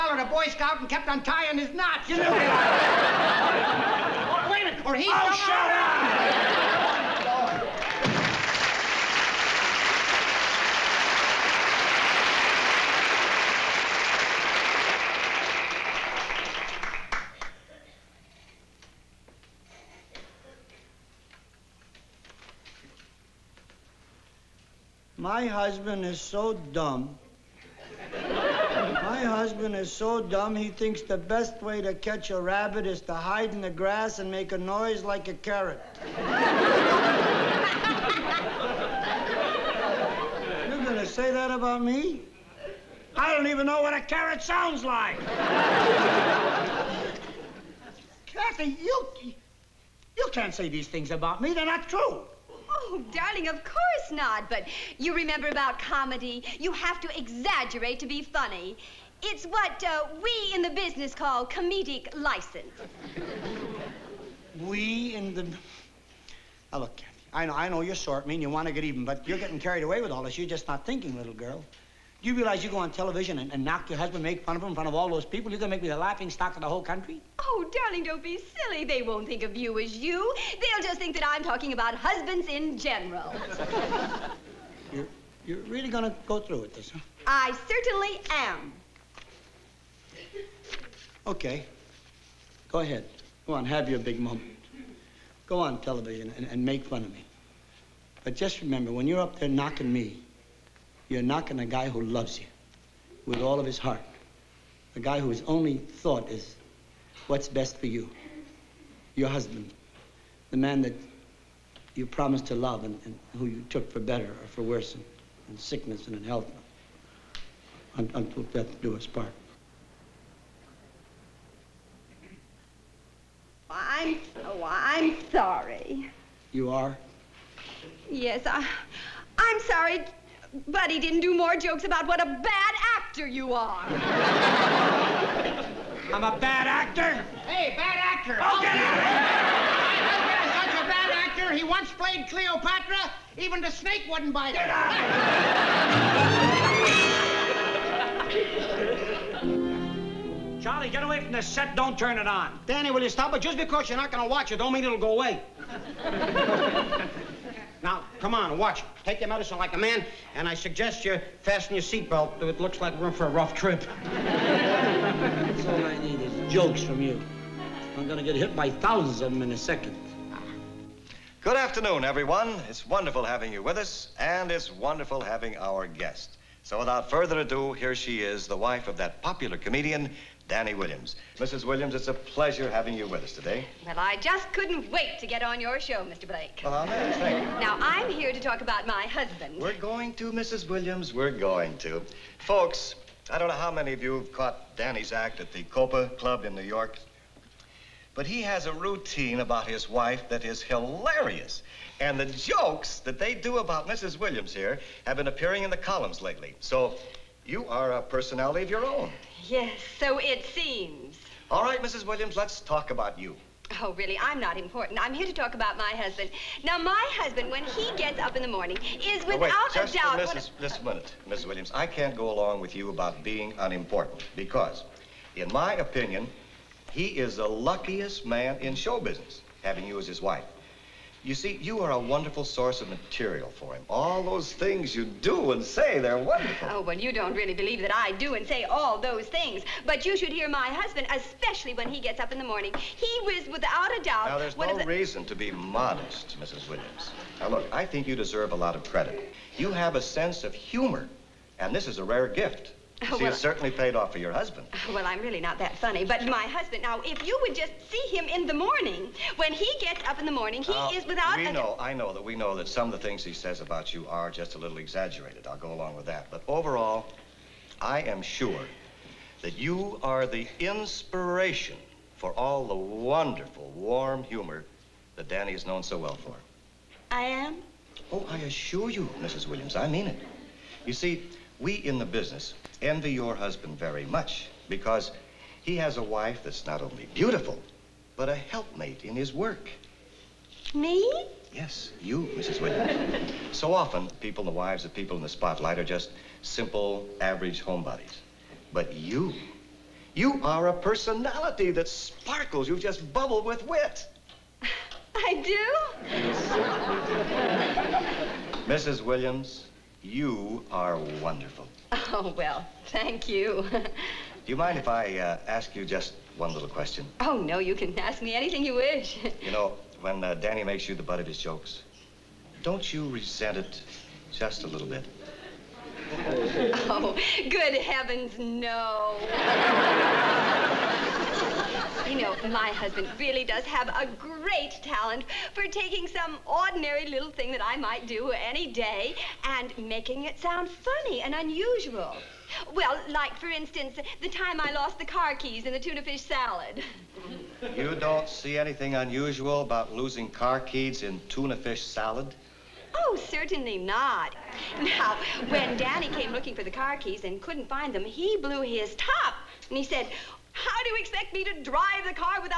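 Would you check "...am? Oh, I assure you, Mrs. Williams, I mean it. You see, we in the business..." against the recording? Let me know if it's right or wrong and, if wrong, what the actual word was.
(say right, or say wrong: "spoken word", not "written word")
right.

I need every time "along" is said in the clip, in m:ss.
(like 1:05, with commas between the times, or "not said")
3:42, 4:25.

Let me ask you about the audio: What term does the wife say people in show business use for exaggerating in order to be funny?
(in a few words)
comedic license.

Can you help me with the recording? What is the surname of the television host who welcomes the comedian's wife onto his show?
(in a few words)
Blake.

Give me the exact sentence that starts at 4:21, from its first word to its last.
We know, I know that we know that some of the things he says about you are just a little exaggerated.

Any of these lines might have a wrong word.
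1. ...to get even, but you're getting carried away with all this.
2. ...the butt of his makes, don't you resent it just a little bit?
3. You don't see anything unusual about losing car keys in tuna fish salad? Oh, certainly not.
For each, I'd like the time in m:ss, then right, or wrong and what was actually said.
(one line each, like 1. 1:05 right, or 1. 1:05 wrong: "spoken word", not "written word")
1. 1:08 right
2. 5:20 wrong: "jokes", not "makes"
3. 5:47 right.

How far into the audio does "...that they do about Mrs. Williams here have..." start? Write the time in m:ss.
3:23.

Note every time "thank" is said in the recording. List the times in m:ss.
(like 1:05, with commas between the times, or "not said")
3:06, 5:12.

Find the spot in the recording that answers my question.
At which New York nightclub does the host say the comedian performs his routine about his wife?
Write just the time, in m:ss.
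3:15.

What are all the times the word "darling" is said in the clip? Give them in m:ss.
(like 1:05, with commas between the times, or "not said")
0:53, 1:17.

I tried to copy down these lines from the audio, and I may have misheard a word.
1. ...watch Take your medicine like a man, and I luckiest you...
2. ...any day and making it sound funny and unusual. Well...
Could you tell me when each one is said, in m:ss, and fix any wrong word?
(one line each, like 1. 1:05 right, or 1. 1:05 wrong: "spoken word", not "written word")
1. 2:38 wrong: "suggest", not "luckiest"
2. 5:38 right.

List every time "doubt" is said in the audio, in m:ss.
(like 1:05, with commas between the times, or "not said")
3:39, 4:04.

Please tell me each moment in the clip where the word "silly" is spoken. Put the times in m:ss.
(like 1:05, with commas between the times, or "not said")
1:18.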